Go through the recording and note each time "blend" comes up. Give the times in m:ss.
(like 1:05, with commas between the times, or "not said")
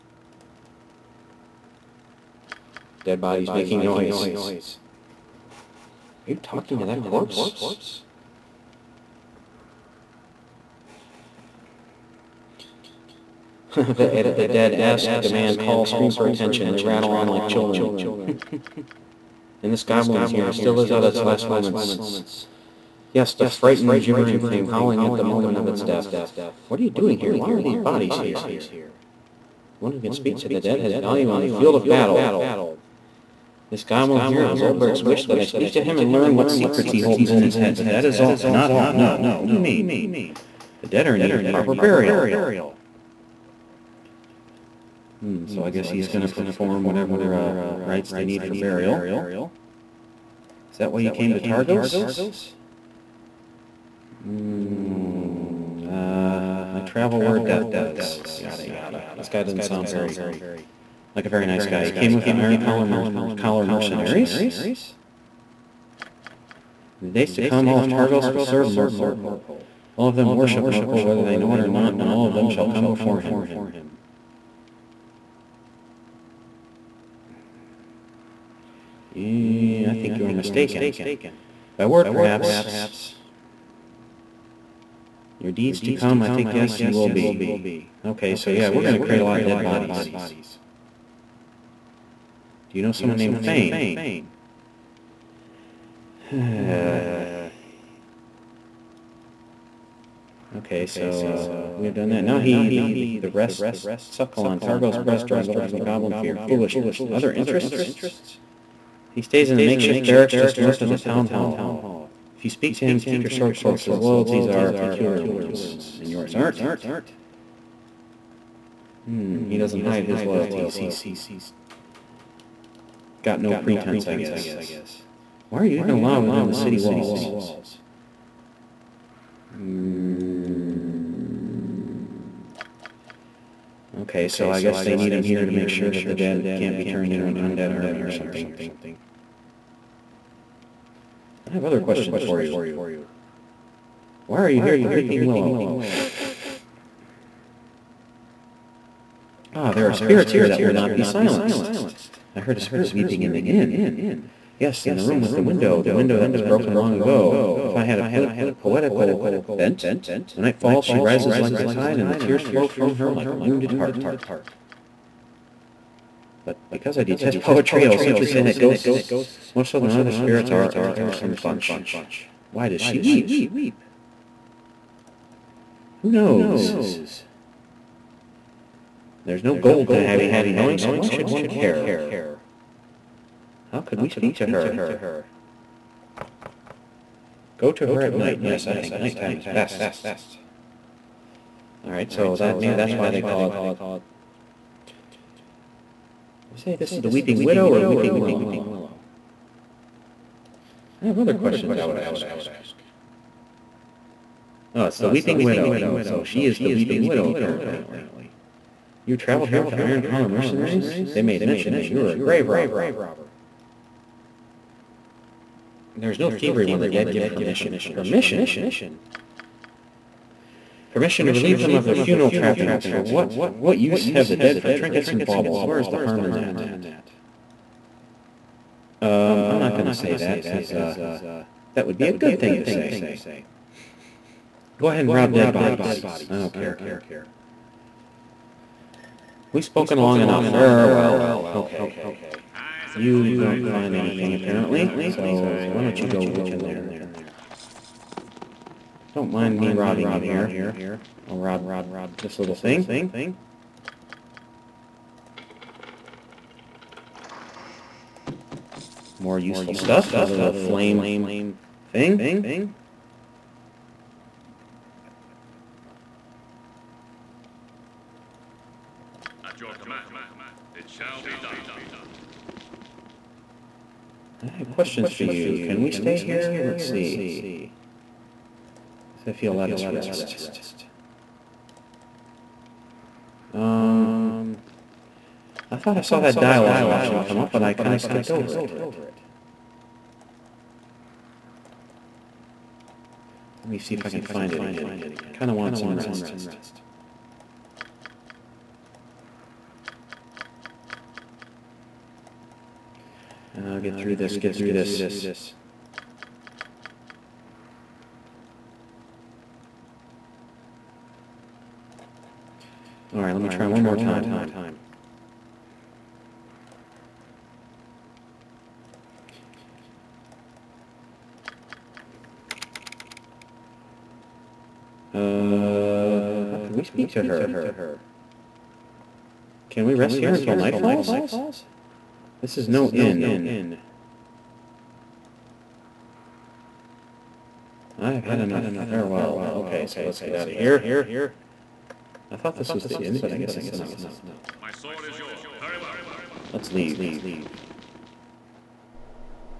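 not said.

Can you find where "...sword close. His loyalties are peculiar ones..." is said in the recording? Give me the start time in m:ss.
1:53.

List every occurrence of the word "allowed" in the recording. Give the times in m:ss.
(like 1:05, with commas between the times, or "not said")
2:05.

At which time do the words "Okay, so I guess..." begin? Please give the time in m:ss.
2:14.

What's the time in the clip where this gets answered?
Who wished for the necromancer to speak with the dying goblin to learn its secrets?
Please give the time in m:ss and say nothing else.
0:34.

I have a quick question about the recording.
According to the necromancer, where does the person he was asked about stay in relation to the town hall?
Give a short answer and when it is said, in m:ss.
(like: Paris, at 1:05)
makeshift barracks just north, at 1:49.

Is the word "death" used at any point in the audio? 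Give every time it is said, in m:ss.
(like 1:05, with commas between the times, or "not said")
0:25, 0:57.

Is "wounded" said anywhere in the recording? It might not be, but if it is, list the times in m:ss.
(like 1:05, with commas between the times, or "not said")
2:43.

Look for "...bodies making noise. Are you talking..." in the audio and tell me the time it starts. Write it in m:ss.
0:03.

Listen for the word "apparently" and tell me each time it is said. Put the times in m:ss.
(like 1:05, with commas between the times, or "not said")
3:27, 4:04.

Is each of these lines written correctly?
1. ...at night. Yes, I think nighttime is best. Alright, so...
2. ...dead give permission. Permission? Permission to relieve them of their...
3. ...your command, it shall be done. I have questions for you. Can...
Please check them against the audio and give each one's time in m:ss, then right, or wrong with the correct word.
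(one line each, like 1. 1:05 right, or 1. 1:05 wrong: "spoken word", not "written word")
1. 3:08 right
2. 3:36 right
3. 4:29 right.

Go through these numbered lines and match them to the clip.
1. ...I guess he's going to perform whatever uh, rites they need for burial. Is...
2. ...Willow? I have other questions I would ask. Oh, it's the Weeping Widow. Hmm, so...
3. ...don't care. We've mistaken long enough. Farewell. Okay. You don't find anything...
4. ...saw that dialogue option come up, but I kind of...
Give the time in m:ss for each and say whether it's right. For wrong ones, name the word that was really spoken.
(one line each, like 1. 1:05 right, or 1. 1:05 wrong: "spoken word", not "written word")
1. 0:45 right
2. 3:18 right
3. 3:56 wrong: "spoken", not "mistaken"
4. 4:46 right.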